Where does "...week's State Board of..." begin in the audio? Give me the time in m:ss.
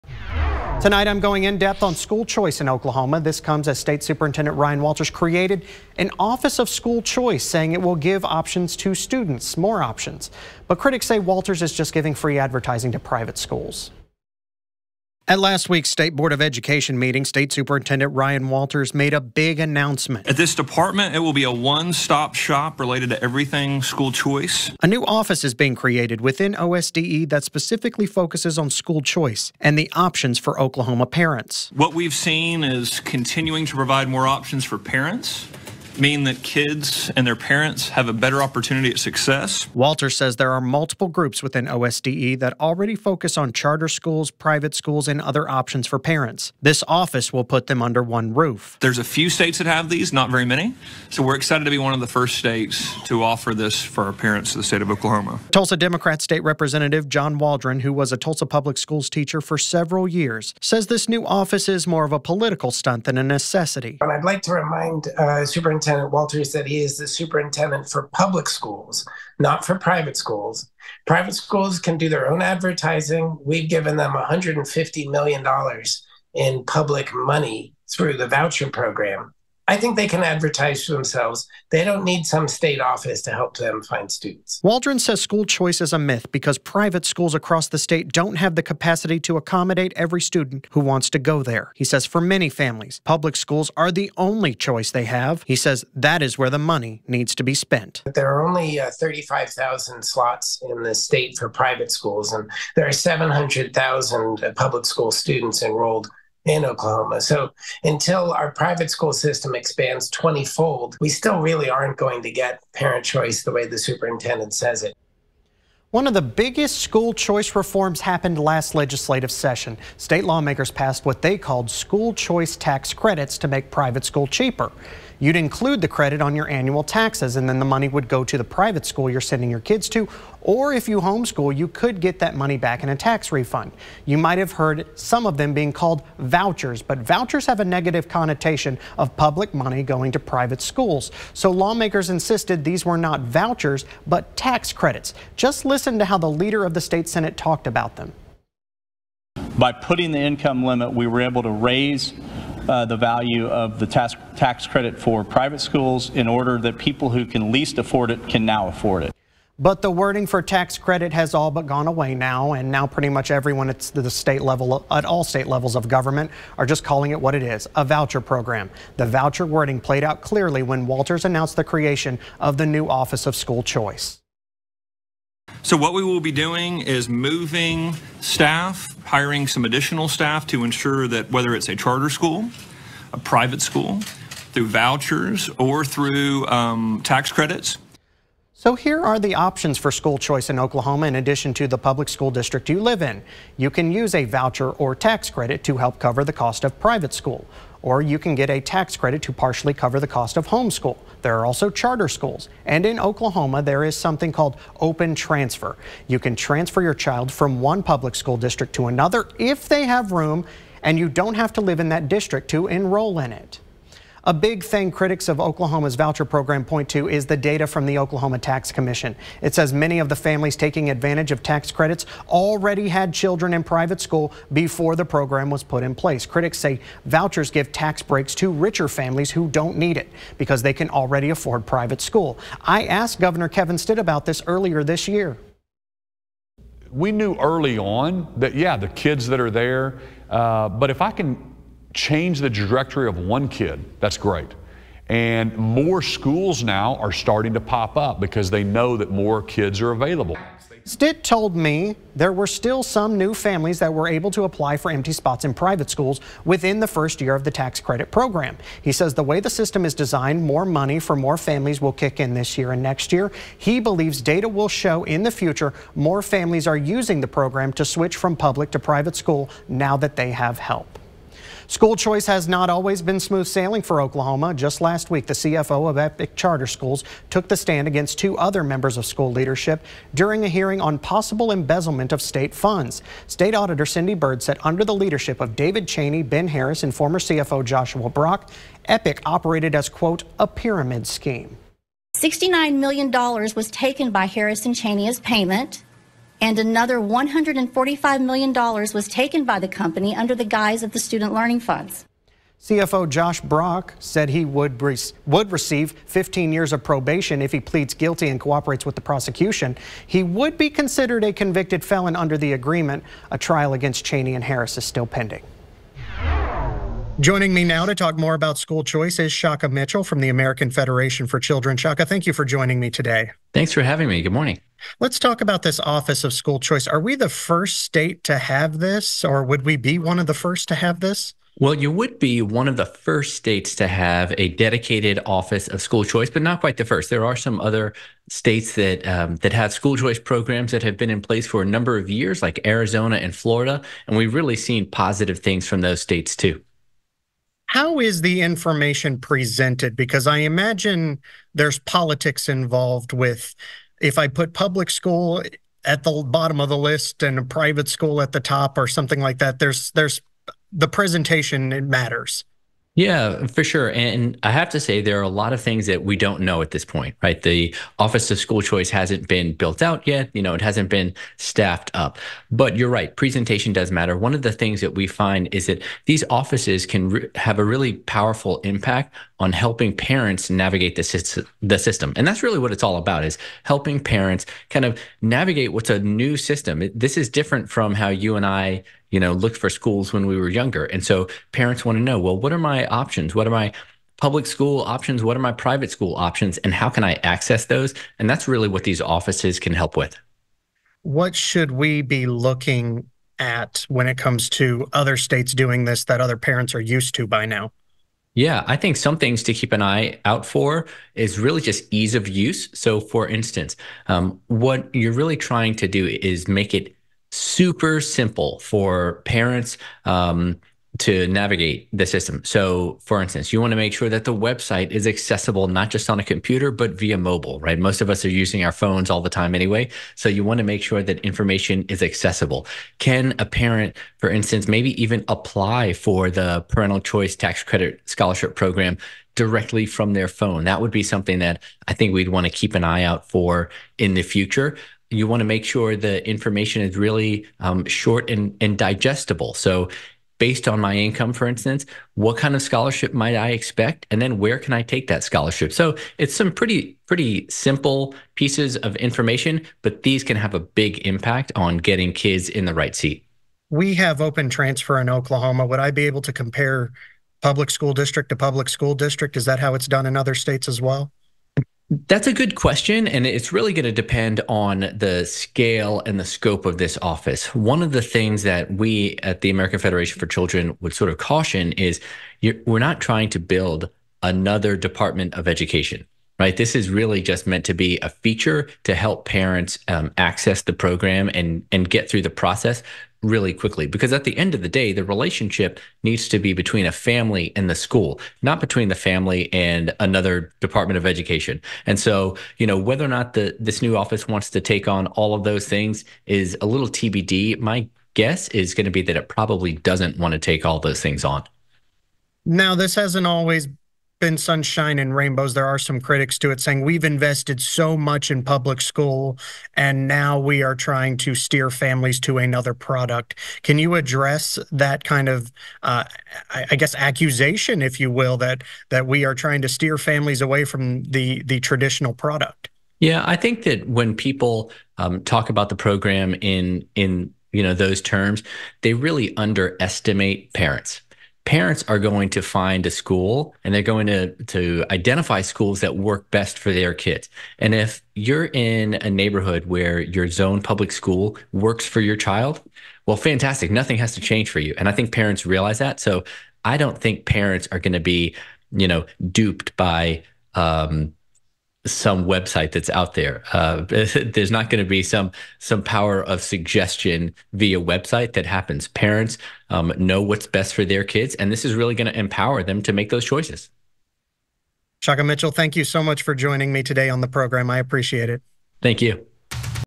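0:15.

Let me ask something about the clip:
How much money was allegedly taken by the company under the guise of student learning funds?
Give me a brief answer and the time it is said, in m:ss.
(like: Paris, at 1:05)
$145 million, at 4:56.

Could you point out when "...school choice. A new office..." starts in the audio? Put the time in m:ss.
0:23.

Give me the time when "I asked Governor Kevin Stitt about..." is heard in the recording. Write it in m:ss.
3:52.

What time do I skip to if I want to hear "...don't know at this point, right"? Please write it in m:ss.
6:06.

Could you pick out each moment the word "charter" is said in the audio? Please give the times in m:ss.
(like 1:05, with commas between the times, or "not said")
0:43, 3:01, 3:21, 4:36.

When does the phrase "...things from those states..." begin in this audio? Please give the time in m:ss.
5:45.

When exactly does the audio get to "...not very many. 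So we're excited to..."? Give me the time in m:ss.
0:50.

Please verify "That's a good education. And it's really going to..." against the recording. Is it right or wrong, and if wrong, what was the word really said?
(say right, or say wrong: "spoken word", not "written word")
wrong: "question", not "education".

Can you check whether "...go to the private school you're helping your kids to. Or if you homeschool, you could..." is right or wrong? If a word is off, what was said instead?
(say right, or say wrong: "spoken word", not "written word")
wrong: "sending", not "helping".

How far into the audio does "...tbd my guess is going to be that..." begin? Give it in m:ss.
8:26.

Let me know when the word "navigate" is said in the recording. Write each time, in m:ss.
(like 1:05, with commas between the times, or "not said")
6:20, 6:25, 7:01.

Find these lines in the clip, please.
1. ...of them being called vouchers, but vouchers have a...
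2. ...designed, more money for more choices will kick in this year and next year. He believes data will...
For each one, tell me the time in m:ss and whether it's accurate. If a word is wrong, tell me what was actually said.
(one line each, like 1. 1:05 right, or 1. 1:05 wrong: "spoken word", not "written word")
1. 2:15 right
2. 4:19 wrong: "families", not "choices".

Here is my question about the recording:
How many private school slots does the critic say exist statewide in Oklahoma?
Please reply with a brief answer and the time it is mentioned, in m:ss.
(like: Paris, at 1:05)
35,000, at 1:38.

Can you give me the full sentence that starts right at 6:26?
This is different from how you and I you know, looked for schools when we were younger.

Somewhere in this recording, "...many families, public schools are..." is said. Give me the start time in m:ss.
1:32.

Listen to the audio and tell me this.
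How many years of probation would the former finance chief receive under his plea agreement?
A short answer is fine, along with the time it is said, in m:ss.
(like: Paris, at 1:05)
15 years, at 5:06.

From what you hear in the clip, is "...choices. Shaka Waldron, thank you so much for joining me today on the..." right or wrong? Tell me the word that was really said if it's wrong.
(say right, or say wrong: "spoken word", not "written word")
wrong: "Mitchell", not "Waldron".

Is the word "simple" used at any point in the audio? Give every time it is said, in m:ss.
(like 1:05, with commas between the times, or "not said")
6:57, 7:37.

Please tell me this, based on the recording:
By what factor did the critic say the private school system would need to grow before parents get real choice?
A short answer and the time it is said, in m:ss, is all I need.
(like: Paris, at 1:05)
20 fold, at 1:50.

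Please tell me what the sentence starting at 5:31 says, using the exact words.
Well, you would be one of the first states to have a dedicated office of school choice, but not quite the first.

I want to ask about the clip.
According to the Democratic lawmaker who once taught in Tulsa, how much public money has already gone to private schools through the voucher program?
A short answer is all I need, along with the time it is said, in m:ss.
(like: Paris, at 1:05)
$150 million, at 1:14.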